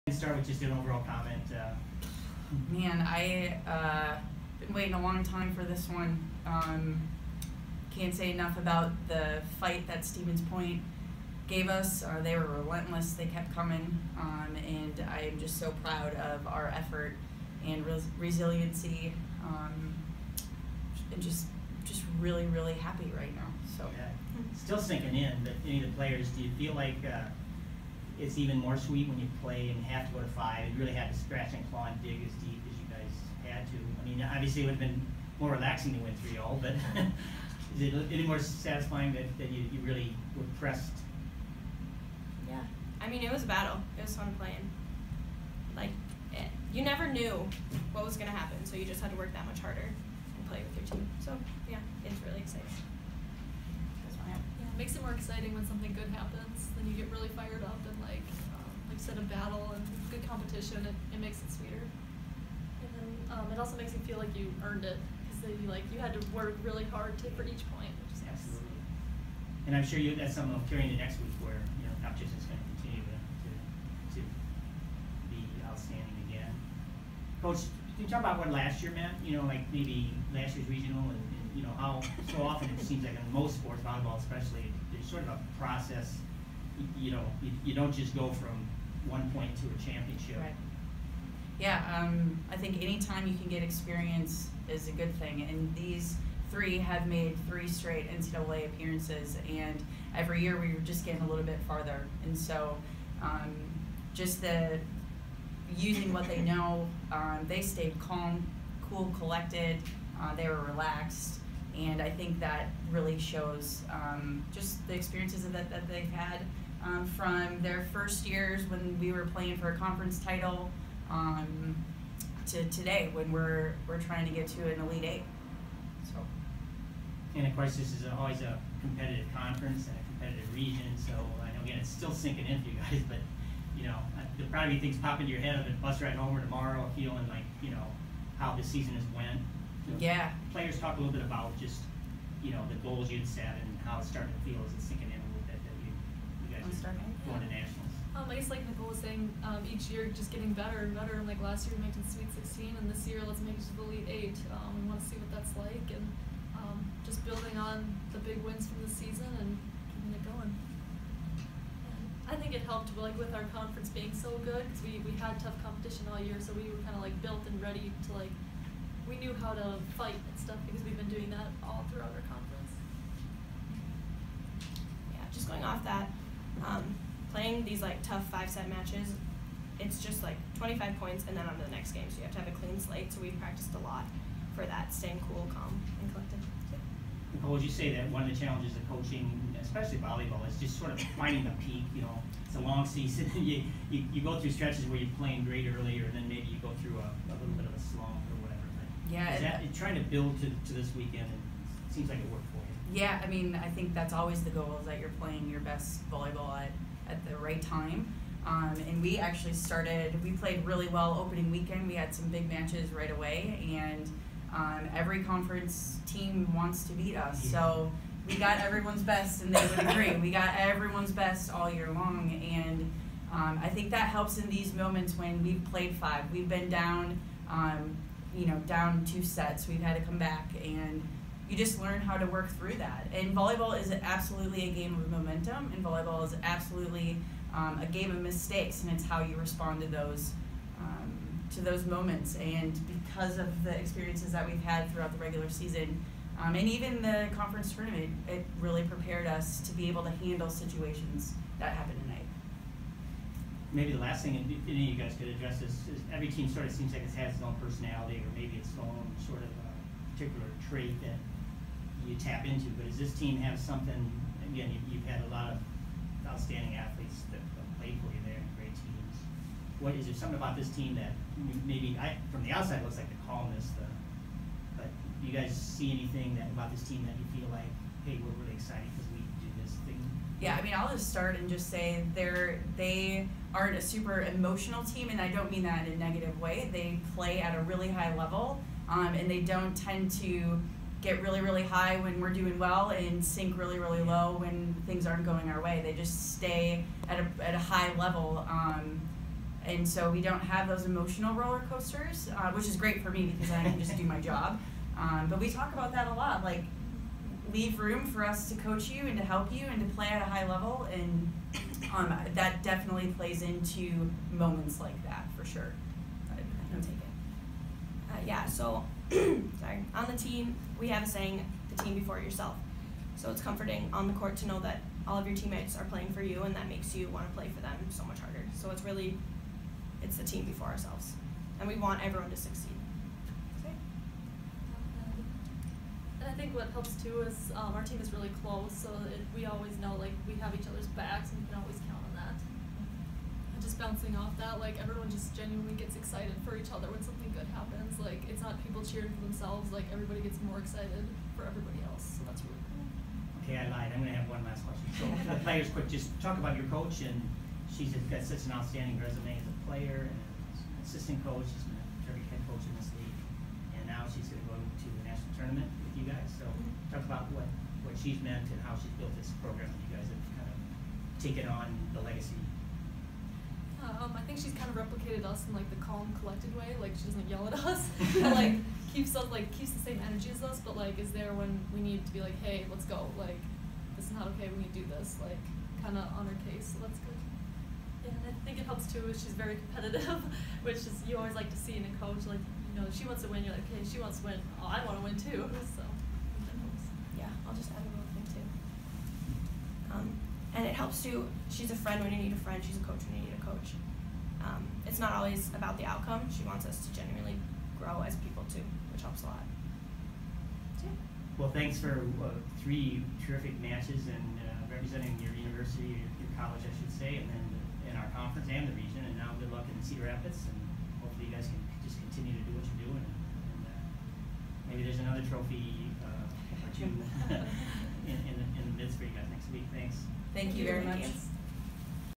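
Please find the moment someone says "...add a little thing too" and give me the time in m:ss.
6:37.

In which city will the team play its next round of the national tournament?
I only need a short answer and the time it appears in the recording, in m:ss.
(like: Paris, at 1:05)
Cedar Rapids, at 6:59.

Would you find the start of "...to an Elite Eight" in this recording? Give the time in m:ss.
2:04.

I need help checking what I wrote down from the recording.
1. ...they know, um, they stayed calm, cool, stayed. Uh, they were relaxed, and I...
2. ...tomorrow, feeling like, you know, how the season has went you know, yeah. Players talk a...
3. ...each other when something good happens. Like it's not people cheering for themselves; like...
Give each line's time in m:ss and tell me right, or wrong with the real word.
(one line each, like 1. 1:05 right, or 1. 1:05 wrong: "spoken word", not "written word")
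1. 1:46 wrong: "collected", not "stayed"
2. 2:16 right
3. 5:46 right.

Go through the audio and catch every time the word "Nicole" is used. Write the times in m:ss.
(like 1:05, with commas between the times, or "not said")
2:28, 3:07.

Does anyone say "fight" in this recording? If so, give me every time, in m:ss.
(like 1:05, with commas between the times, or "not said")
0:09, 2:49.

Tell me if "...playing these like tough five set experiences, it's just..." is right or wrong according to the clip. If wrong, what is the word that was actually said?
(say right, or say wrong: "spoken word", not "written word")
wrong: "matches", not "experiences".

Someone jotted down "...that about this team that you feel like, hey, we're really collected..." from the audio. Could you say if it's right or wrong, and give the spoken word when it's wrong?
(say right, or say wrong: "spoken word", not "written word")
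wrong: "excited", not "collected".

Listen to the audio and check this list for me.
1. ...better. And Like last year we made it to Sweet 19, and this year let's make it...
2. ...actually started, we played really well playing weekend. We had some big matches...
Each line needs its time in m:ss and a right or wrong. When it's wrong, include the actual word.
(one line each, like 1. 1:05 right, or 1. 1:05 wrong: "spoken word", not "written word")
1. 2:30 wrong: "16", not "19"
2. 3:29 wrong: "opening", not "playing".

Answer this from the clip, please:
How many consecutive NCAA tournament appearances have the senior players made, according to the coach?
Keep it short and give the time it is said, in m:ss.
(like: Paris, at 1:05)
3, at 1:37.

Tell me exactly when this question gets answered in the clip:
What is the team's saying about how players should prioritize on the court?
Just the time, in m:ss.
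5:21.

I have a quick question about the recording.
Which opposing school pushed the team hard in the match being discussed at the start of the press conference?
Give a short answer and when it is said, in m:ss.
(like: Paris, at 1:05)
Stevens Point, at 0:10.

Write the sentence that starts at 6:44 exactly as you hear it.
Um, it's not always about the outcome, she wants us to genuinely grow as people too, which helps a lot.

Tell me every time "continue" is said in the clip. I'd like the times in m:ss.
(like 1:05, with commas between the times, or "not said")
1:12, 7:02.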